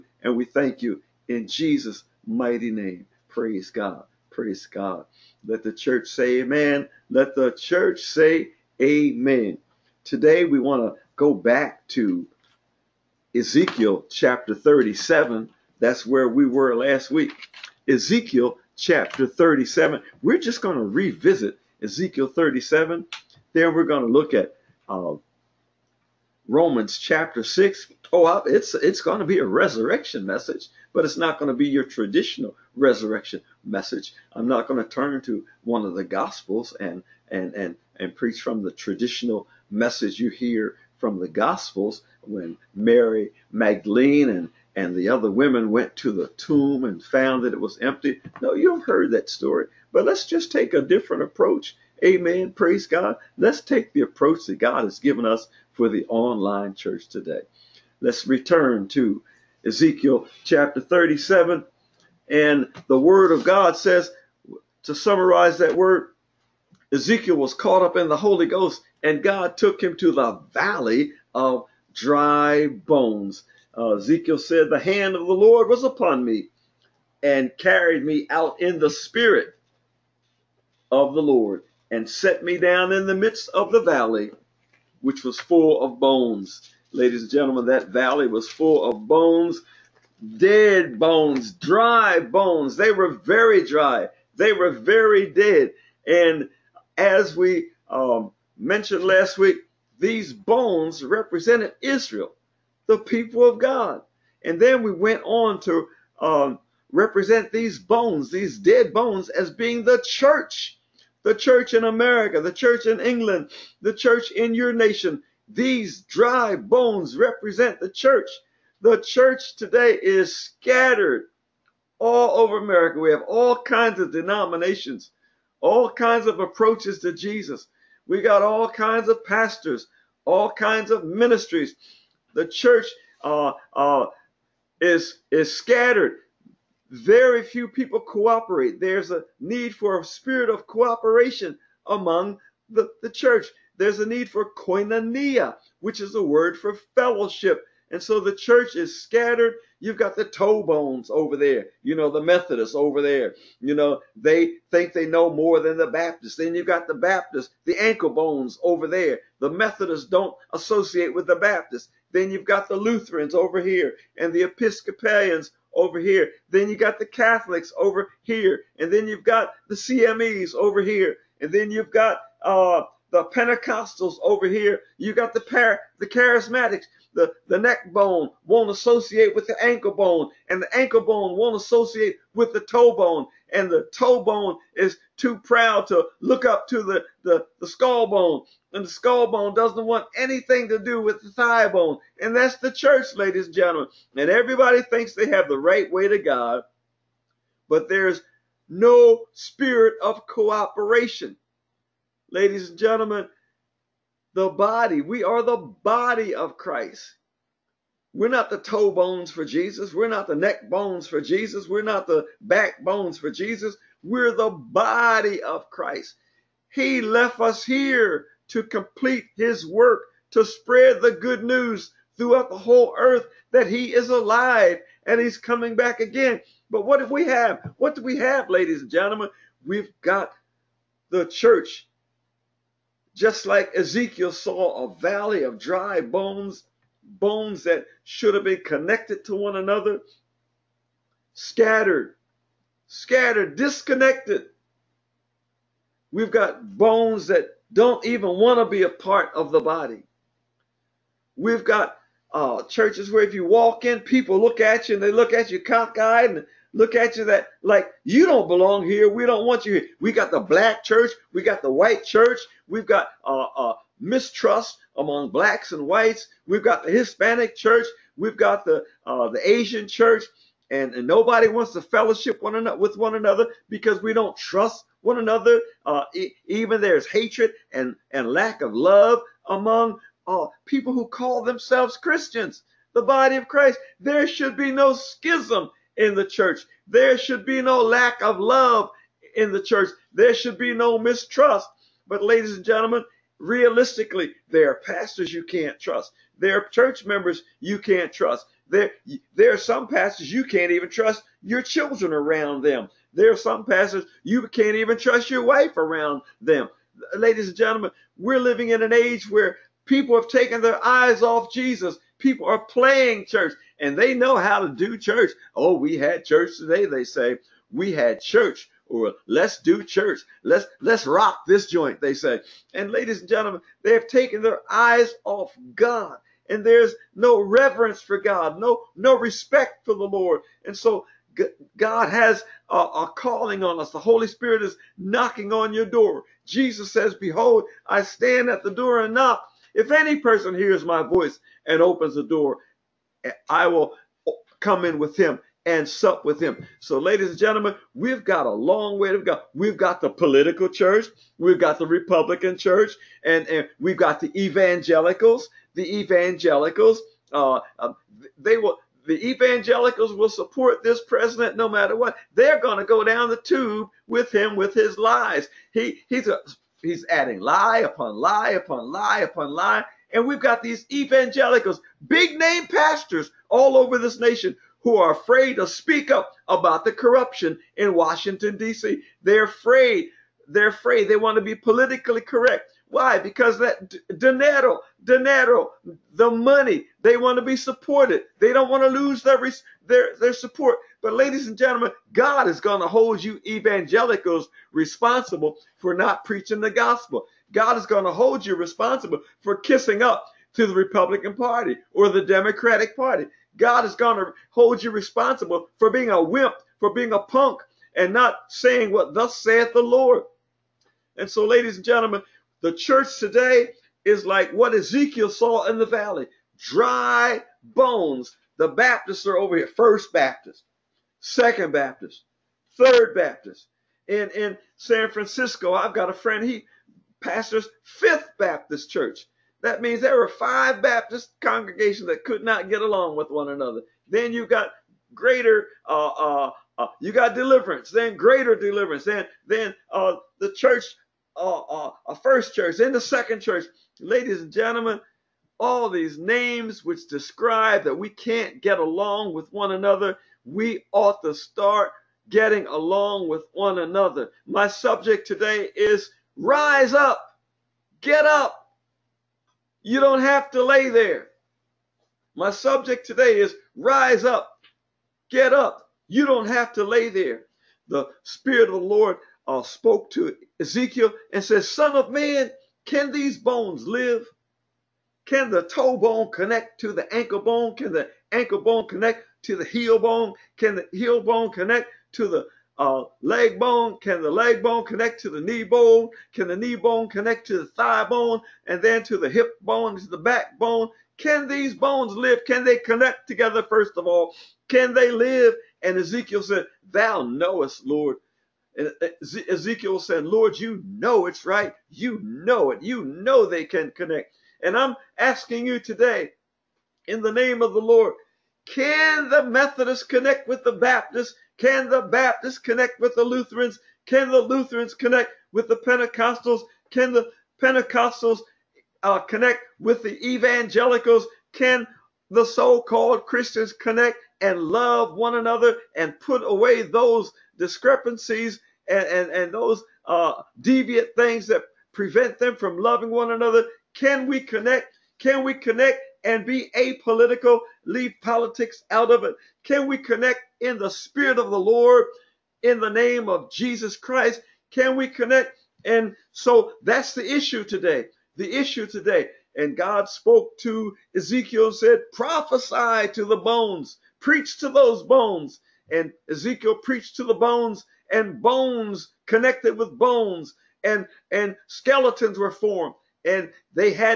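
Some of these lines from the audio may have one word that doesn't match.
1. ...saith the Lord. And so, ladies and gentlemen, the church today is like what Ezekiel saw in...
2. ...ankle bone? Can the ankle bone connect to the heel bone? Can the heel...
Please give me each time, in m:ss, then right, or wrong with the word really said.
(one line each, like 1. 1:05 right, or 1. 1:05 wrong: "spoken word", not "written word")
1. 6:49 right
2. 7:57 right.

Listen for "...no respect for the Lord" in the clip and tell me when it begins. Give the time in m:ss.
5:28.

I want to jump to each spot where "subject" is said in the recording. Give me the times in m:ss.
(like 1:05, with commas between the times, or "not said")
7:34, 7:42.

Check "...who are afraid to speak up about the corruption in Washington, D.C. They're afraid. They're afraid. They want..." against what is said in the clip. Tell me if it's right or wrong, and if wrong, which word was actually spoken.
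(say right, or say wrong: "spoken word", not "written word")
right.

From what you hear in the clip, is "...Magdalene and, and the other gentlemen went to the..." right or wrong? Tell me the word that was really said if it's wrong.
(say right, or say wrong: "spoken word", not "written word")
wrong: "women", not "gentlemen".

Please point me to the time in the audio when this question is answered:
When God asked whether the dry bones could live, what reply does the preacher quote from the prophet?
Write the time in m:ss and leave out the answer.
8:16.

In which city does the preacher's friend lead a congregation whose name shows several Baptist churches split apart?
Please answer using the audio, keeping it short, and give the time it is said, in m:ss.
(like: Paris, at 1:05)
San Francisco, at 7:04.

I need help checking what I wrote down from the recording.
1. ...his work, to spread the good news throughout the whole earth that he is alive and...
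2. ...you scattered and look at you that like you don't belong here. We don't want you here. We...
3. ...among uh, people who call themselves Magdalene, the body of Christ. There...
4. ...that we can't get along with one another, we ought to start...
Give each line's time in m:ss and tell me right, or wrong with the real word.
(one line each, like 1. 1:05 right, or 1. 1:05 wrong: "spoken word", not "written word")
1. 3:39 right
2. 4:15 wrong: "cockeyed", not "scattered"
3. 4:39 wrong: "Christians", not "Magdalene"
4. 7:27 right.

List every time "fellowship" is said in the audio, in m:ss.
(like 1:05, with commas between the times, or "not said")
2:26, 4:31.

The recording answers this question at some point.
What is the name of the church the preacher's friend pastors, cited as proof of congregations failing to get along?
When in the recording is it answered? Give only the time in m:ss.
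7:07.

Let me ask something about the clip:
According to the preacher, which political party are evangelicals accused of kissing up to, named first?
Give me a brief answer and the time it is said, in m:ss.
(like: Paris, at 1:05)
Republican Party, at 6:40.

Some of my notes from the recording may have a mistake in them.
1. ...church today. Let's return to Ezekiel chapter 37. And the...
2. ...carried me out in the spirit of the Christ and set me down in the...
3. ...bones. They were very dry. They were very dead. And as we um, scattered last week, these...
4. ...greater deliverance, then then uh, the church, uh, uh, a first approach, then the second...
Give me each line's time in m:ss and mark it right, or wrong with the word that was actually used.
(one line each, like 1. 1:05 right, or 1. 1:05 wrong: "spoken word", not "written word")
1. 0:56 right
2. 1:17 wrong: "Lord", not "Christ"
3. 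1:32 wrong: "mentioned", not "scattered"
4. 7:18 wrong: "church", not "approach".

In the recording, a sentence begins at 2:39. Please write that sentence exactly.
The Methodists don't associate with the Baptists.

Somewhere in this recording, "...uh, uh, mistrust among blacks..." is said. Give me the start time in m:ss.
4:23.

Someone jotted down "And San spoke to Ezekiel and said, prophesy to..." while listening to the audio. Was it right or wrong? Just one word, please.
wrong.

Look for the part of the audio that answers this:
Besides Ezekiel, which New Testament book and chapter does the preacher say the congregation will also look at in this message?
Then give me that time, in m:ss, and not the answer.
0:26.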